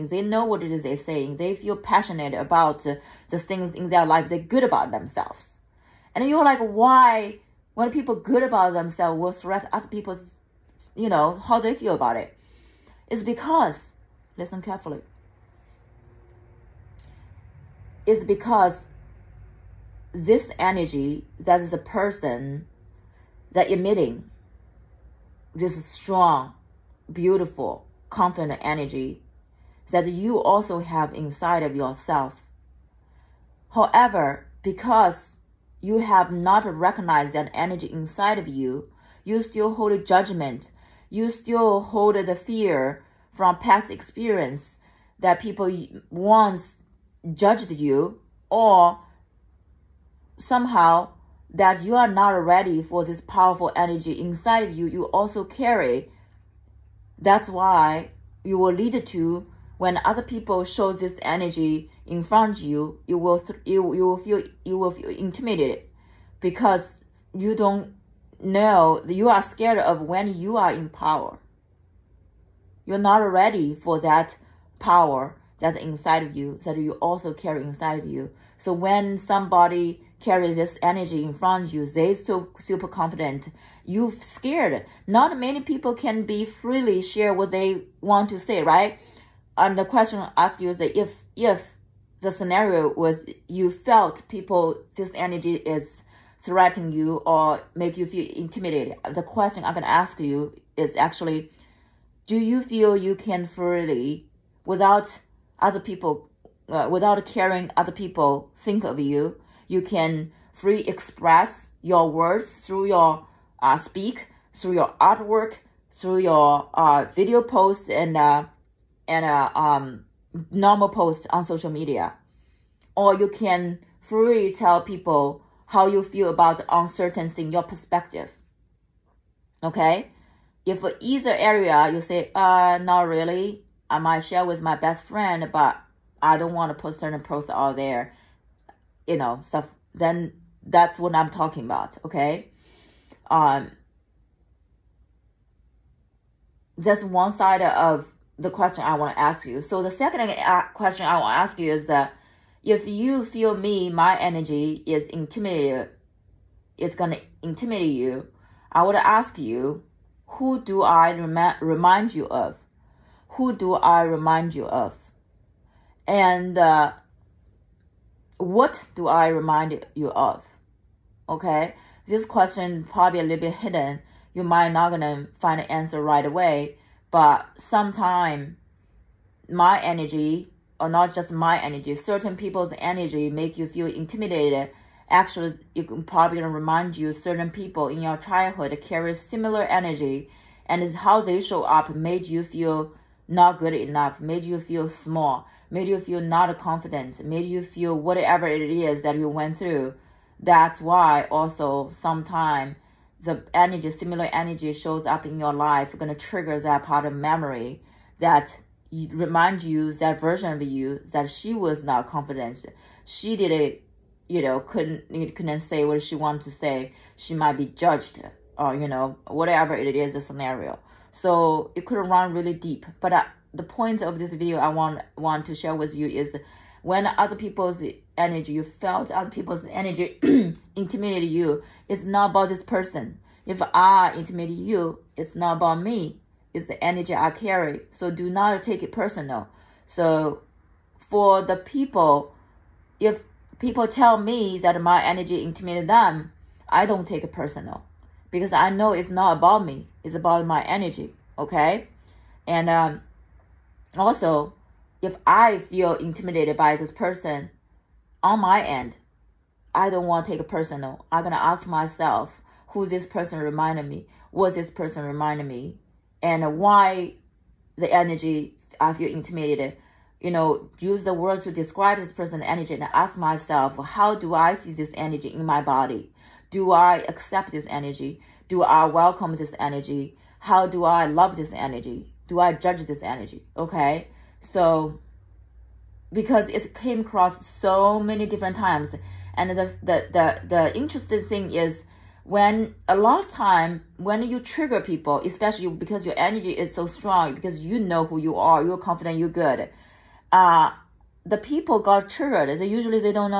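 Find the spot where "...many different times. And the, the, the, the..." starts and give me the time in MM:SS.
04:47.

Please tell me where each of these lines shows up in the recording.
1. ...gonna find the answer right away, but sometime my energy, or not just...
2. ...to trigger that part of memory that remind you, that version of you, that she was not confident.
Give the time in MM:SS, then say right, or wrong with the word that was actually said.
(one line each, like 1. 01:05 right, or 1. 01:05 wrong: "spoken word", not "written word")
1. 02:54 right
2. 03:26 right.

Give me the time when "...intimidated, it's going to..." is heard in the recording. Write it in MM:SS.
02:35.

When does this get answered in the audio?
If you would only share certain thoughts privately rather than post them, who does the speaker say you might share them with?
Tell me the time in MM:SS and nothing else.
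02:14.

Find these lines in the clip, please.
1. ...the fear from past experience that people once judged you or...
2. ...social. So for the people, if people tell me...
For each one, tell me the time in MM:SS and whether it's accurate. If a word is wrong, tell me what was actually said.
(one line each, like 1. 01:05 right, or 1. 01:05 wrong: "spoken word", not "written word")
1. 00:42 right
2. 03:58 wrong: "personal", not "social".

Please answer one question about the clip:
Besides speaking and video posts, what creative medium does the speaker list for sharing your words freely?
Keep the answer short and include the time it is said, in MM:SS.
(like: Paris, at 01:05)
artwork, at 01:54.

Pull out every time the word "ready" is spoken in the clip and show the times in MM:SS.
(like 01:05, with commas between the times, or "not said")
00:52, 01:13.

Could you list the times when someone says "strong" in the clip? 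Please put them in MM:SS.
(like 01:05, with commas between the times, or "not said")
00:25, 04:56.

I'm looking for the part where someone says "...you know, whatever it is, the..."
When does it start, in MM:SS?
03:38.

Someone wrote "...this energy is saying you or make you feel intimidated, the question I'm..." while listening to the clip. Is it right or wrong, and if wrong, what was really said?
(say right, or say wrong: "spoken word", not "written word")
wrong: "threatening", not "saying".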